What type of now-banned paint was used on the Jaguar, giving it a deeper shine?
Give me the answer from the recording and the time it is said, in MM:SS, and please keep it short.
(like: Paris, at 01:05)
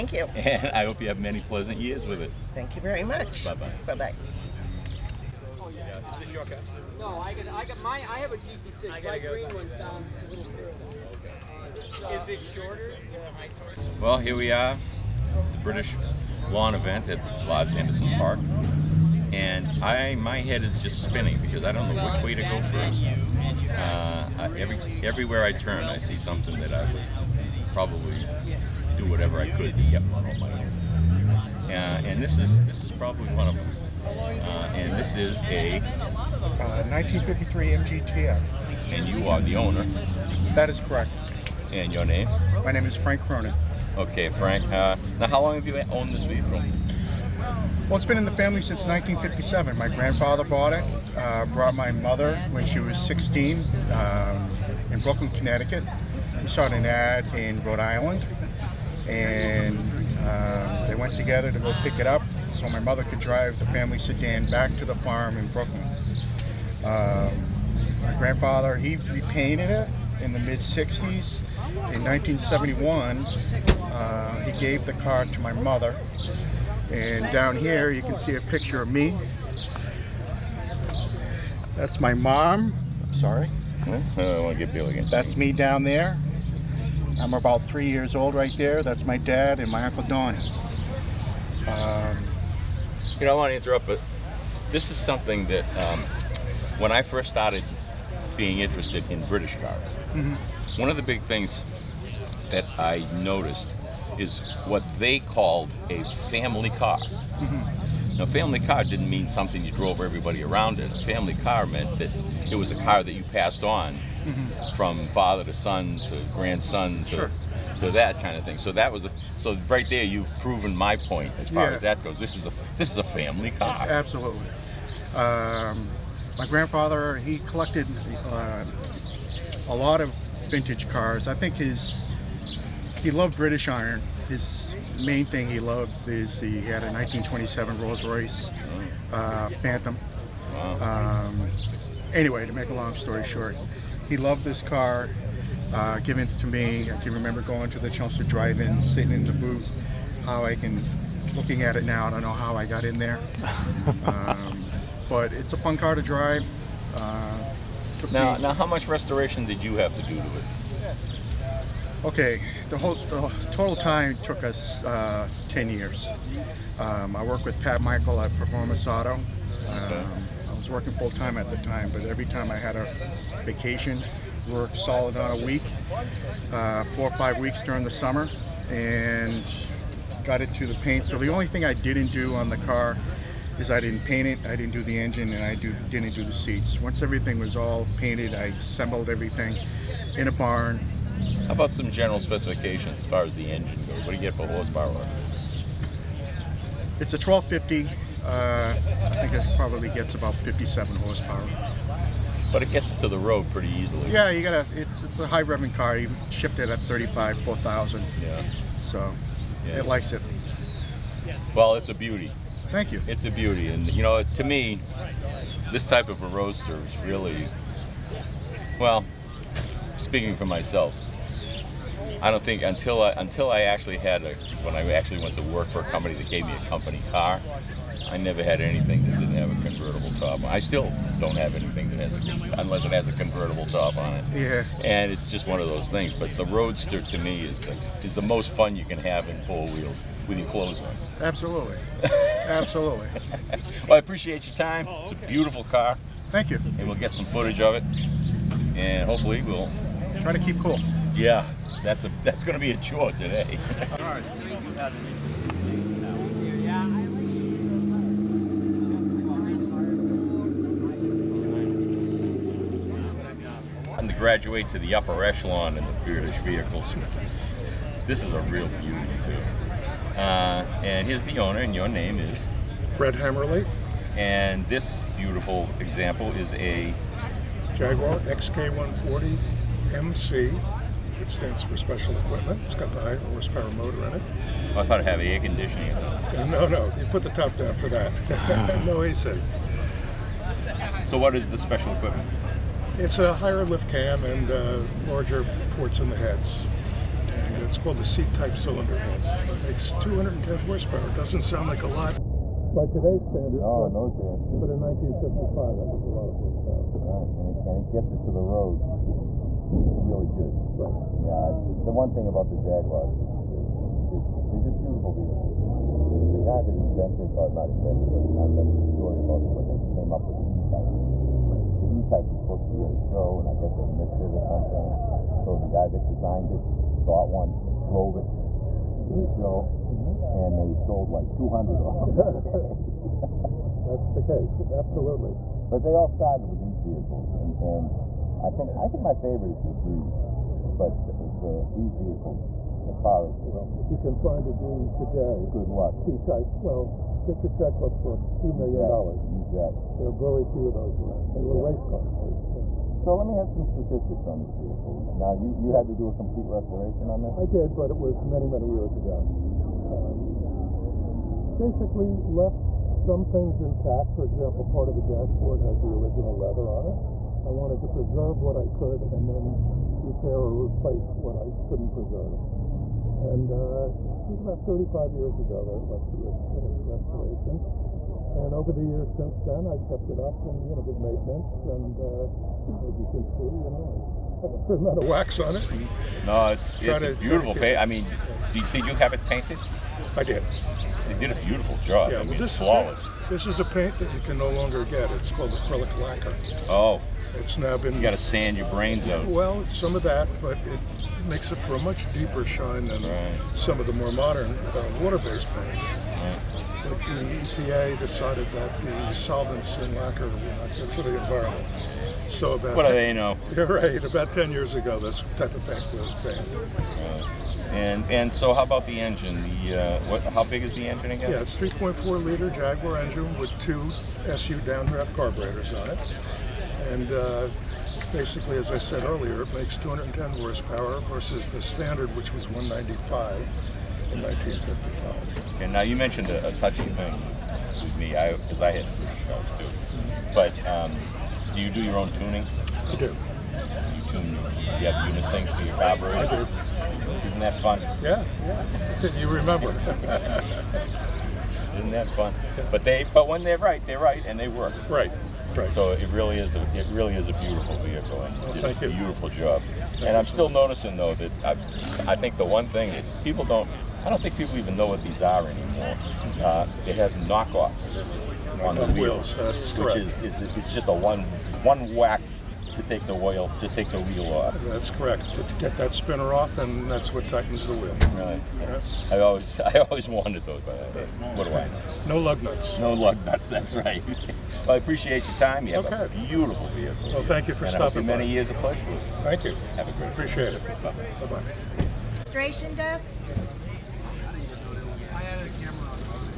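acrylic lacquer, at 06:35.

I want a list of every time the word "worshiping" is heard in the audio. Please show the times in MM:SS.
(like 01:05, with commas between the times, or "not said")
not said.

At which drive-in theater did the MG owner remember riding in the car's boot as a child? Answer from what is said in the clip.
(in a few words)
Chelmsford Drive-In.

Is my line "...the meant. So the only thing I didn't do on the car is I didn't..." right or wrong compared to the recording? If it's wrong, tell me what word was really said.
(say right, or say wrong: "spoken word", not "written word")
wrong: "paint", not "meant".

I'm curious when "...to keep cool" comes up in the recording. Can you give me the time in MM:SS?
04:10.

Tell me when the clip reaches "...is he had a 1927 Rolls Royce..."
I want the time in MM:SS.
02:16.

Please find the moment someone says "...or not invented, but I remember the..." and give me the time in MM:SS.
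05:17.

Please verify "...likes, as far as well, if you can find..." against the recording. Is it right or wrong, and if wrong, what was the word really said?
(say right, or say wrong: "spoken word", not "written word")
wrong: "vehicles", not "likes".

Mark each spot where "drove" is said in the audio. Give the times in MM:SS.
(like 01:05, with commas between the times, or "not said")
01:49, 05:27.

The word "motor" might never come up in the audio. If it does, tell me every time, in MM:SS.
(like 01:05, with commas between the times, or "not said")
04:43.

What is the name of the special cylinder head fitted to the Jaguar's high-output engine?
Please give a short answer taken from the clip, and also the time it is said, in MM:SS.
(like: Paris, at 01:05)
C-type, at 04:58.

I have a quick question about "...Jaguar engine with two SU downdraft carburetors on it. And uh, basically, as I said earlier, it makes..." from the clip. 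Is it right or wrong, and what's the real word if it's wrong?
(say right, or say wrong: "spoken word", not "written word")
right.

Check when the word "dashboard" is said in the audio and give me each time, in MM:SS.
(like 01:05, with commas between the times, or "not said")
06:05.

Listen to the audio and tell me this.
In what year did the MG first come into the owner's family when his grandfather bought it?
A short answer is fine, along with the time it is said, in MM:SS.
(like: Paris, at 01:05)
1957, at 00:48.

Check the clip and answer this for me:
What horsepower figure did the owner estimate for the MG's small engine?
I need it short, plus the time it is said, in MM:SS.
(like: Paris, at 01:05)
57, at 03:20.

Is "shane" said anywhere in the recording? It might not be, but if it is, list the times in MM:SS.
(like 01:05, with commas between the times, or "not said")
not said.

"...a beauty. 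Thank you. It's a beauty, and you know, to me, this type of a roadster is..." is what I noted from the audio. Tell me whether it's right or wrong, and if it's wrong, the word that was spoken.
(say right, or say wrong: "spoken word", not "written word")
right.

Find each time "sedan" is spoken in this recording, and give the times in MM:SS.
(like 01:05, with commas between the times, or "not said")
01:03.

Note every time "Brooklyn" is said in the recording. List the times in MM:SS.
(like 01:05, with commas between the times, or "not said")
00:54, 01:05.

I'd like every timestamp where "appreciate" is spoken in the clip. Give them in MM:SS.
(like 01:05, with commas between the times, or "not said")
04:03, 08:04, 08:10.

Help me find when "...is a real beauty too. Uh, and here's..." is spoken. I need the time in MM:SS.
04:28.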